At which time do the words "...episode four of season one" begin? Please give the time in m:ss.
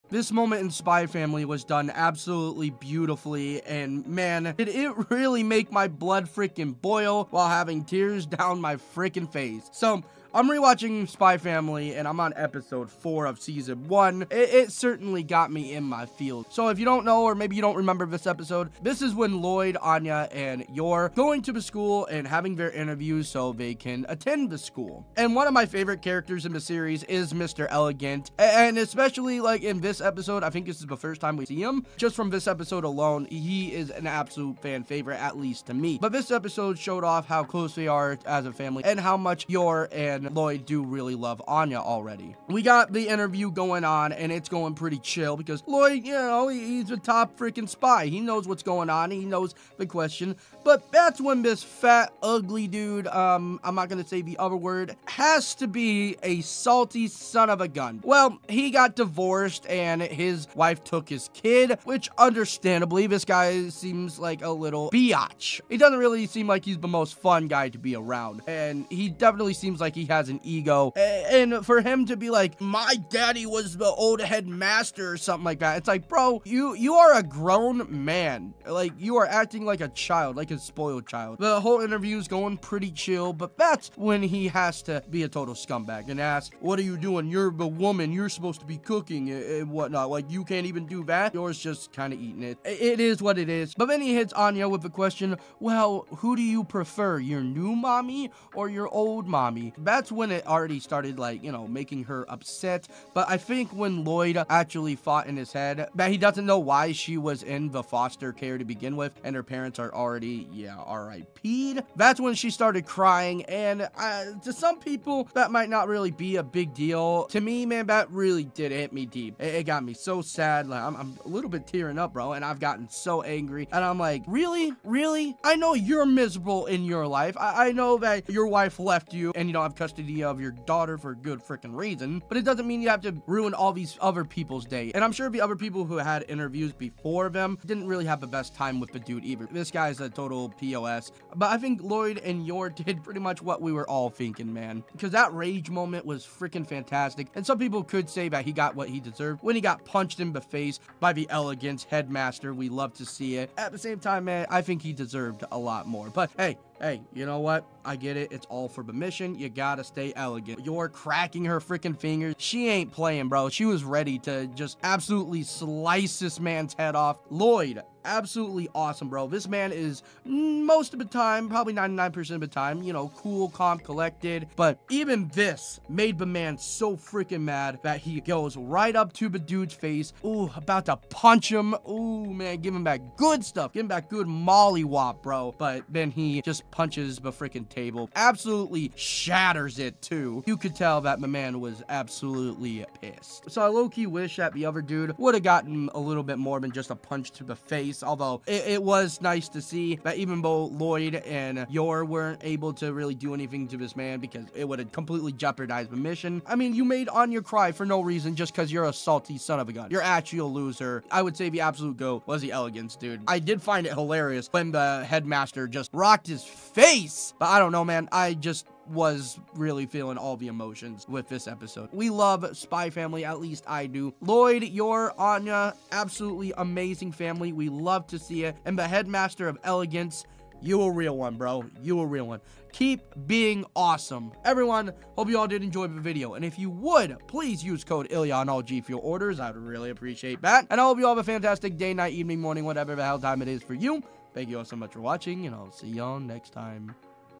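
0:12.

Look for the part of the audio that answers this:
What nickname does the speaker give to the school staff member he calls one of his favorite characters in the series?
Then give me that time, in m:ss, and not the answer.
0:27.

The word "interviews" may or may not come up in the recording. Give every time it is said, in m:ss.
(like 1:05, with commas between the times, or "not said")
0:22, 0:43, 1:21, 2:16.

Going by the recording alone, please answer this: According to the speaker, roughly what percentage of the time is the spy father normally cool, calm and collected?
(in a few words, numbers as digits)
99%.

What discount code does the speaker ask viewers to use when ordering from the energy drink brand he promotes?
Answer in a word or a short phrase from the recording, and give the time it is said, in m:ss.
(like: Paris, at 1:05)
ILLYA, at 3:58.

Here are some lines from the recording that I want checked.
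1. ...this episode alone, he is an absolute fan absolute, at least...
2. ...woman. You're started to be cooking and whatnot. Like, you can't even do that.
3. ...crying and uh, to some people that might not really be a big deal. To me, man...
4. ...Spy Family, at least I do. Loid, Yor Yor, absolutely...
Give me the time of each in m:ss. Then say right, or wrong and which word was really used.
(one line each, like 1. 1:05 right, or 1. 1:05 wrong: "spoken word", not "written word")
1. 0:32 wrong: "favorite", not "absolute"
2. 1:27 wrong: "supposed", not "started"
3. 1:52 right
4. 3:42 wrong: "Anya", not "Yor".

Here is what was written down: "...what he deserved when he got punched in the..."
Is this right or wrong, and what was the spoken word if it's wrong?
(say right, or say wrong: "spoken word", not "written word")
right.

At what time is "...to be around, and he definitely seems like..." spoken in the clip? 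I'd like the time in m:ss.
1:07.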